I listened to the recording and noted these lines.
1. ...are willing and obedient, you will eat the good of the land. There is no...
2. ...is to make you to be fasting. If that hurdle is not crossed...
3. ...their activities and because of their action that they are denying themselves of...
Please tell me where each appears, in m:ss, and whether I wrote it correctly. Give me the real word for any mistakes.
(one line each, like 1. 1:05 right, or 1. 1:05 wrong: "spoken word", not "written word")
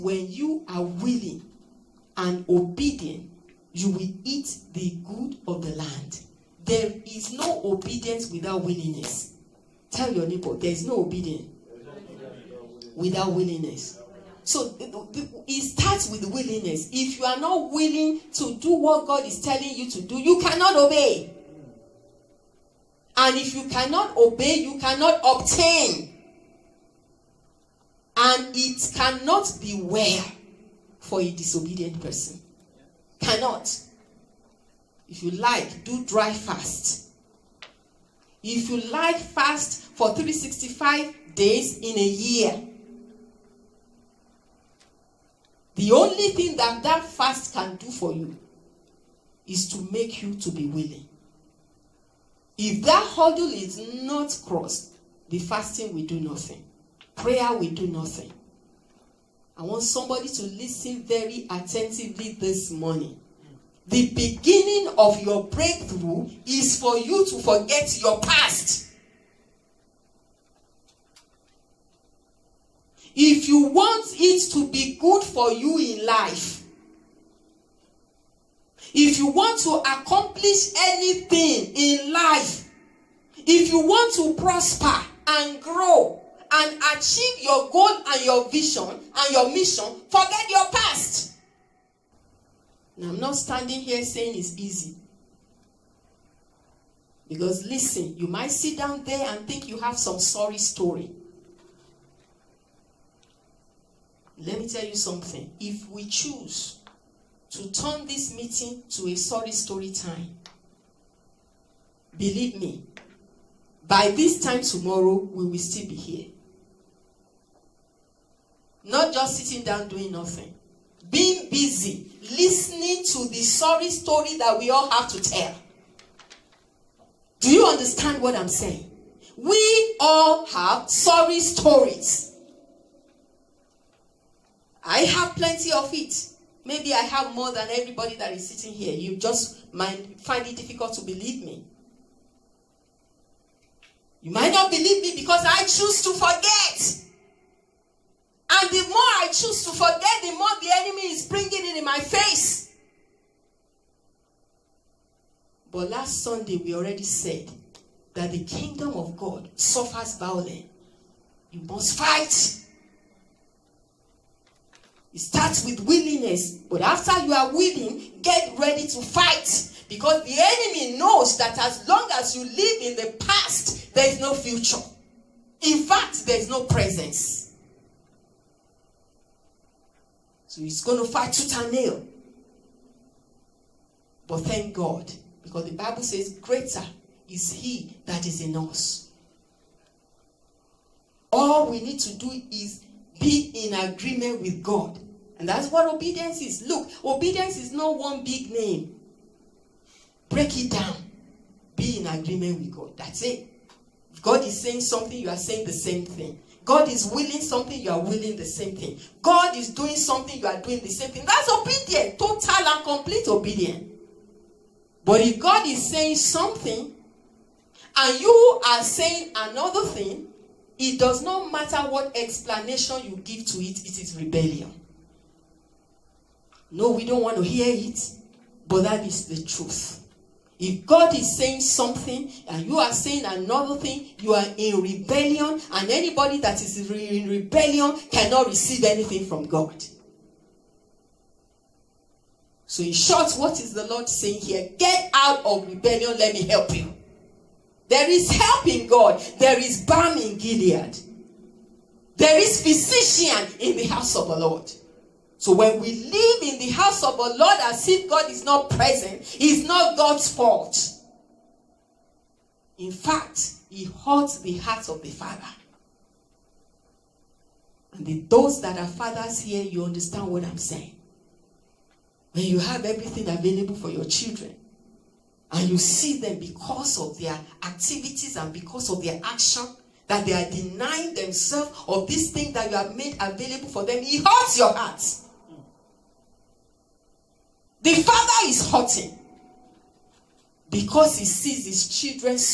1. 0:00 right
2. 0:49 wrong: "willing", not "fasting"
3. 4:37 right.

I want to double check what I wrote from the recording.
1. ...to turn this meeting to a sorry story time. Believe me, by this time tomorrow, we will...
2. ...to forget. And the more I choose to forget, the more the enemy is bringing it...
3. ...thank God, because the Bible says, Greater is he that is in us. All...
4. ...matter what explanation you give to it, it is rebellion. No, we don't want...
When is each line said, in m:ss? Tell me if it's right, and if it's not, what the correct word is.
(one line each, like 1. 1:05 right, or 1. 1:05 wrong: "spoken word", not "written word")
1. 1:47 right
2. 2:26 right
3. 3:04 right
4. 3:41 right.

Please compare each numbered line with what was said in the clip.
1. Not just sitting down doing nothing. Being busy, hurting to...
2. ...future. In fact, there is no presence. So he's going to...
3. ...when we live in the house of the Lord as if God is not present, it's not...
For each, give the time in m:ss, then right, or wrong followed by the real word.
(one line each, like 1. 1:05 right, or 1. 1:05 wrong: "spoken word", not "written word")
1. 1:58 wrong: "listening", not "hurting"
2. 2:54 right
3. 4:15 right.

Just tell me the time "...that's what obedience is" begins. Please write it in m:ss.
3:15.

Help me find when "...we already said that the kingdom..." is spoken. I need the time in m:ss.
2:36.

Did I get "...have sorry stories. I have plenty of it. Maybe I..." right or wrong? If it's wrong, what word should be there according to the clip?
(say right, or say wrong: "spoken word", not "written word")
right.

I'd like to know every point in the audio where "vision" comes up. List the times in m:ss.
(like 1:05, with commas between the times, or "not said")
1:28.